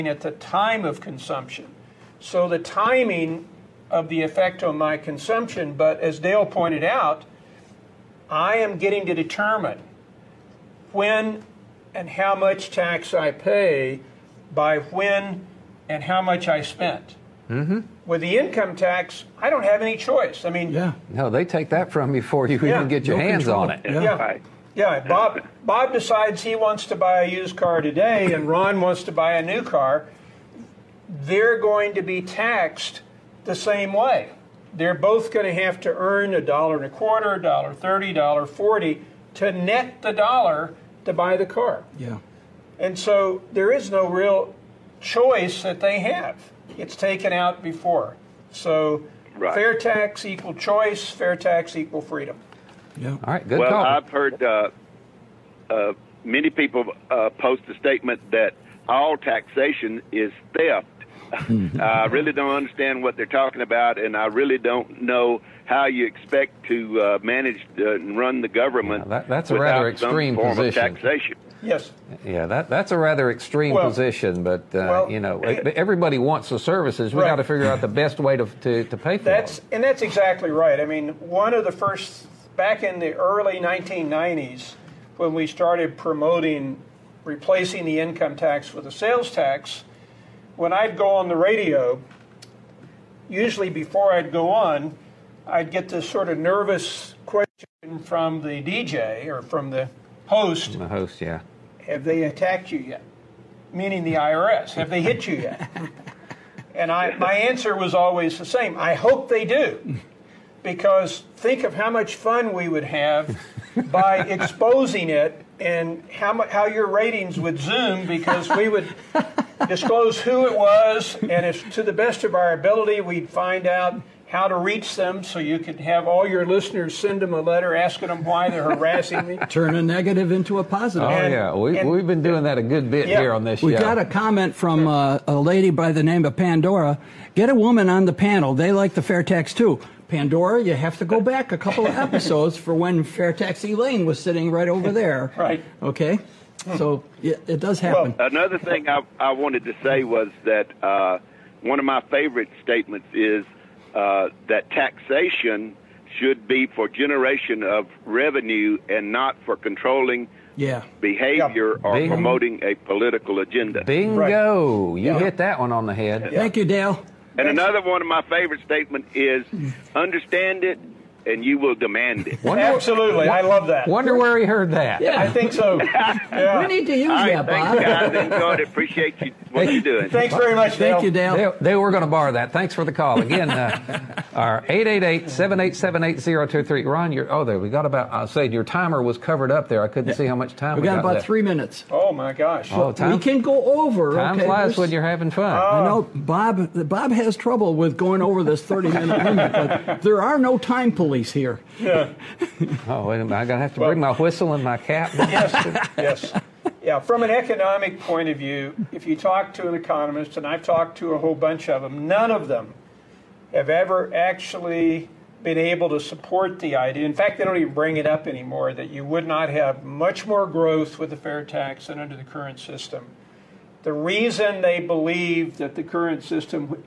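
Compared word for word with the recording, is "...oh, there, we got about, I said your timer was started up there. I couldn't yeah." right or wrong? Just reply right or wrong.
wrong.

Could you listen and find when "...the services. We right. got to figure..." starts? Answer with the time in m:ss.
1:16.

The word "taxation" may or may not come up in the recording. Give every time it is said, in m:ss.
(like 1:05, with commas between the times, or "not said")
0:59, 2:34.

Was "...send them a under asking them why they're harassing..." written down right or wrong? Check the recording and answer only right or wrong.
wrong.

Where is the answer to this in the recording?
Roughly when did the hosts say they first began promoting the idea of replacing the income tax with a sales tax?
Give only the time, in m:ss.
1:23.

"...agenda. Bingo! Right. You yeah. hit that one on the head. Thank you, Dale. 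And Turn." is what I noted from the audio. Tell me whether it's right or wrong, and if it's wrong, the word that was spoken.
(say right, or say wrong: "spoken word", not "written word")
wrong: "Thanks", not "Turn".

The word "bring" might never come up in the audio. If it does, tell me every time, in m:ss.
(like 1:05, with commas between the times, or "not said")
3:23, 3:37.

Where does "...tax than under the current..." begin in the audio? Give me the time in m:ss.
3:41.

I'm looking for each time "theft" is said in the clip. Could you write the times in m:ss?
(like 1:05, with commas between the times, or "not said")
1:00.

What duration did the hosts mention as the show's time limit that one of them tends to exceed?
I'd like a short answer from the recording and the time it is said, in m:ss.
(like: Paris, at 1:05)
30 minutes, at 3:18.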